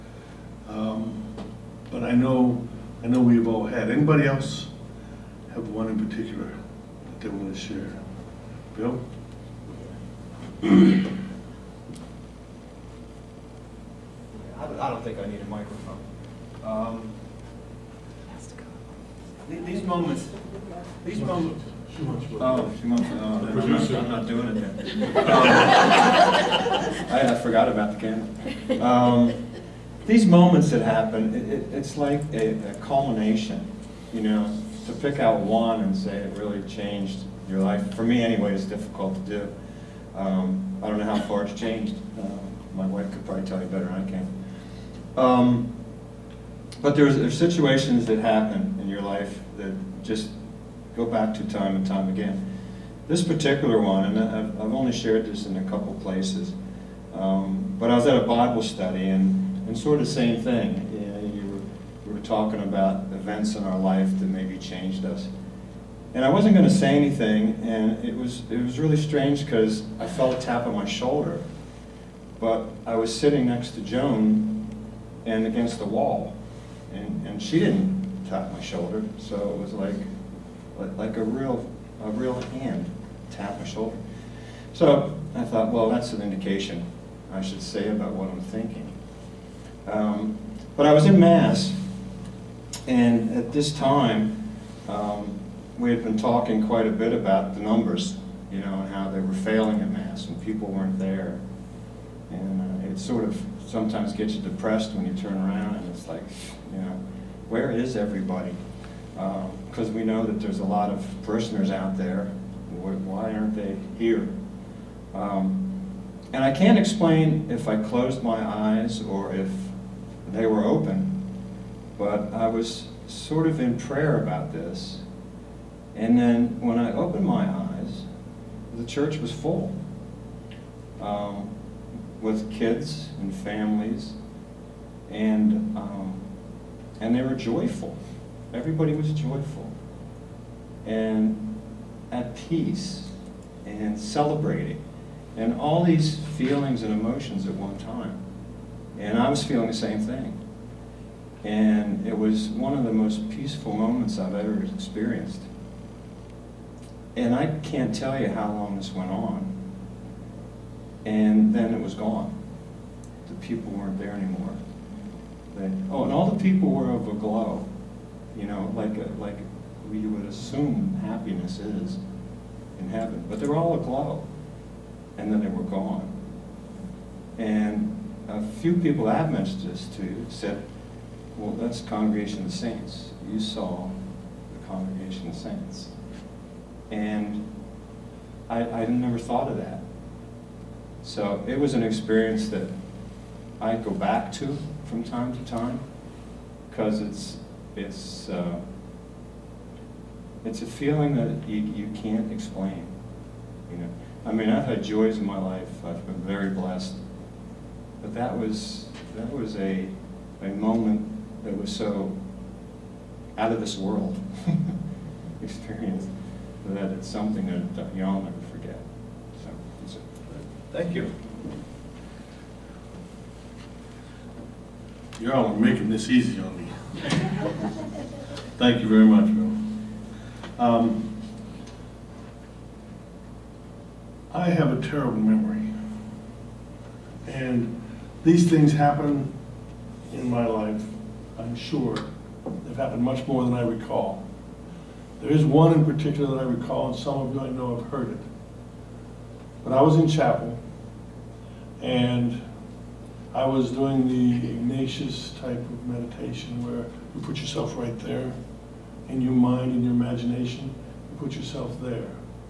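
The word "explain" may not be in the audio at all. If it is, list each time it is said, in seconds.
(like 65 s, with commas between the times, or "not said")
116 s, 202 s.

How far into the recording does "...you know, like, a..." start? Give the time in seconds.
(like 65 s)
168 s.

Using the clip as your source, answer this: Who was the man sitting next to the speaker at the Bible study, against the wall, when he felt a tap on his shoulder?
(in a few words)
Joan.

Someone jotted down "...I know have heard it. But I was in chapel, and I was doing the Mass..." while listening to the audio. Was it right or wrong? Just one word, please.
wrong.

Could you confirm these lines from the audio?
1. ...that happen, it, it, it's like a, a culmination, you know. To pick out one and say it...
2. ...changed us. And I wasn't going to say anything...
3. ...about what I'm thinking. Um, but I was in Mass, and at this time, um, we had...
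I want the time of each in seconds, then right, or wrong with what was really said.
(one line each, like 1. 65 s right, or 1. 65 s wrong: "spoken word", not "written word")
1. 30 s right
2. 64 s right
3. 87 s right.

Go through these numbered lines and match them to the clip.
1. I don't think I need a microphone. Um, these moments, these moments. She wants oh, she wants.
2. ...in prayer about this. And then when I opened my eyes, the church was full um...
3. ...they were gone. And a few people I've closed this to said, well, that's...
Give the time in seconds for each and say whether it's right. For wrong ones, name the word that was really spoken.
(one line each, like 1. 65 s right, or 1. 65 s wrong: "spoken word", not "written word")
1. 14 s right
2. 123 s right
3. 175 s wrong: "mentioned", not "closed".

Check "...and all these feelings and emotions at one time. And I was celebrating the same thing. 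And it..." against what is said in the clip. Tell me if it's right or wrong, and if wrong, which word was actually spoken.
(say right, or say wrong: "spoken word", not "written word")
wrong: "feeling", not "celebrating".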